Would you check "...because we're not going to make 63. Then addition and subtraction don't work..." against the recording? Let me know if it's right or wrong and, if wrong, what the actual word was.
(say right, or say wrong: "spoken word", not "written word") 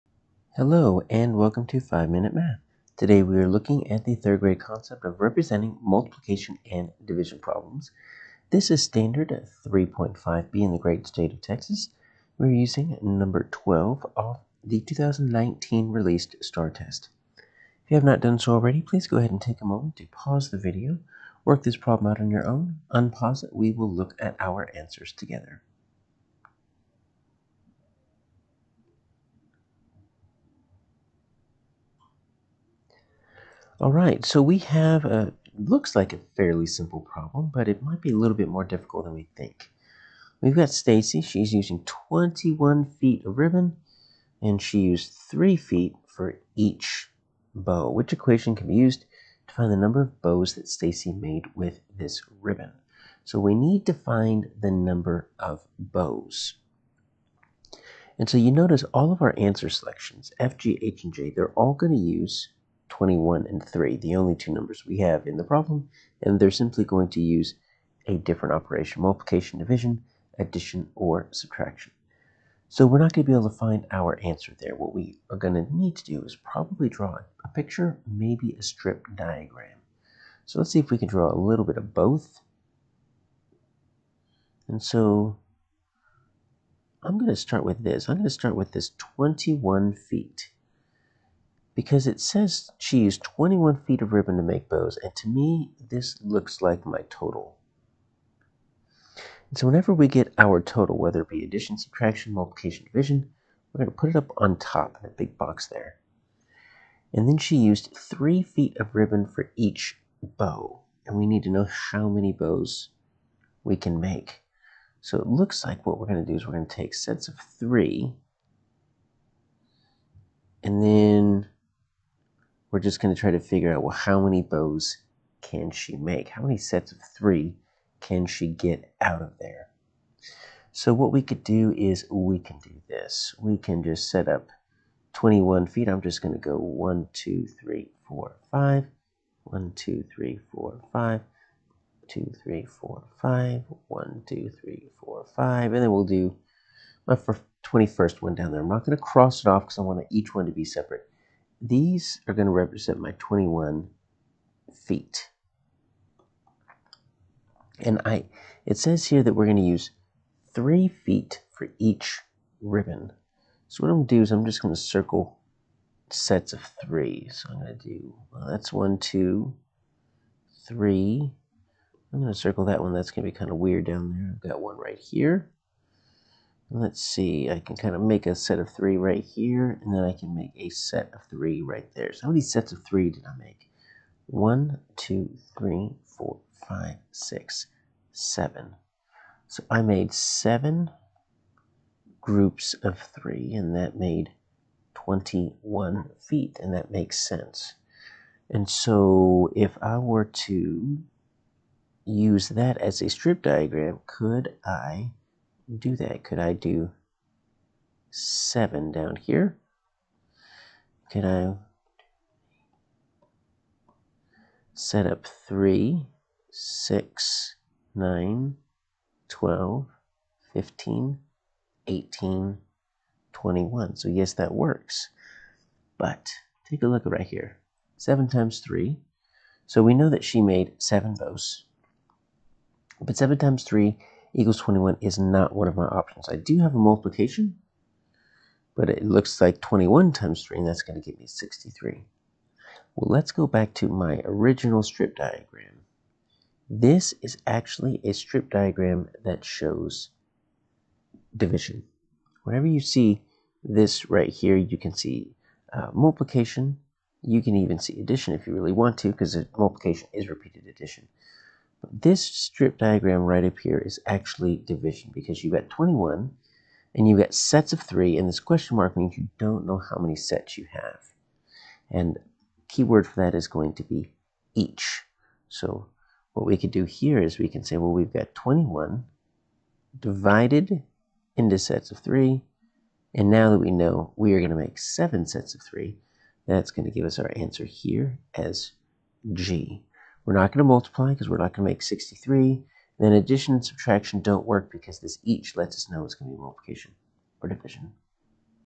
right.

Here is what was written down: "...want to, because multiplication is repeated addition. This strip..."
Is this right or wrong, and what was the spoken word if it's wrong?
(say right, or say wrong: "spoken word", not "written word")
right.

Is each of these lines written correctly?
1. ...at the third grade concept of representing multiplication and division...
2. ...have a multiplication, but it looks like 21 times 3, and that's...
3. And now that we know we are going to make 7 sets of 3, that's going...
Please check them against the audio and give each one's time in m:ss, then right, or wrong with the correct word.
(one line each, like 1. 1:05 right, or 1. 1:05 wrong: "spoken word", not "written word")
1. 0:03 right
2. 3:56 right
3. 4:43 right.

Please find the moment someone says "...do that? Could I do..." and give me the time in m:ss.
3:25.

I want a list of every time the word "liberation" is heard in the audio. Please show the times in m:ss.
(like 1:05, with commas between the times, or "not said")
not said.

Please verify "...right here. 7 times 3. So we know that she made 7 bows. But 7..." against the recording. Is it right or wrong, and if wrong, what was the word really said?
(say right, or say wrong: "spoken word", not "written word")
right.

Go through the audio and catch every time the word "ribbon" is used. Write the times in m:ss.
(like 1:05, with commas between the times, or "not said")
0:43, 0:52, 1:34, 1:48, 2:42.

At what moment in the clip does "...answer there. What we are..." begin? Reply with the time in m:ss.
1:14.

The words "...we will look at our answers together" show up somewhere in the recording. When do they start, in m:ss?
0:23.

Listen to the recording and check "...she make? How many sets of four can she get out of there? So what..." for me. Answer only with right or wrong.
wrong.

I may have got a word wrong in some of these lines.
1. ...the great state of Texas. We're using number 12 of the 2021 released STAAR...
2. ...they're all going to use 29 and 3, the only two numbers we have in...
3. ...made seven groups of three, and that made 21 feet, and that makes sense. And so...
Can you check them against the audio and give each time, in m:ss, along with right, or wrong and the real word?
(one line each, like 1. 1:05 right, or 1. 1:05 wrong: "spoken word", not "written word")
1. 0:10 wrong: "2019", not "2021"
2. 1:01 wrong: "21", not "29"
3. 3:09 right.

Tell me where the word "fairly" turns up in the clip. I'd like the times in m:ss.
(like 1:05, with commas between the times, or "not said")
0:36.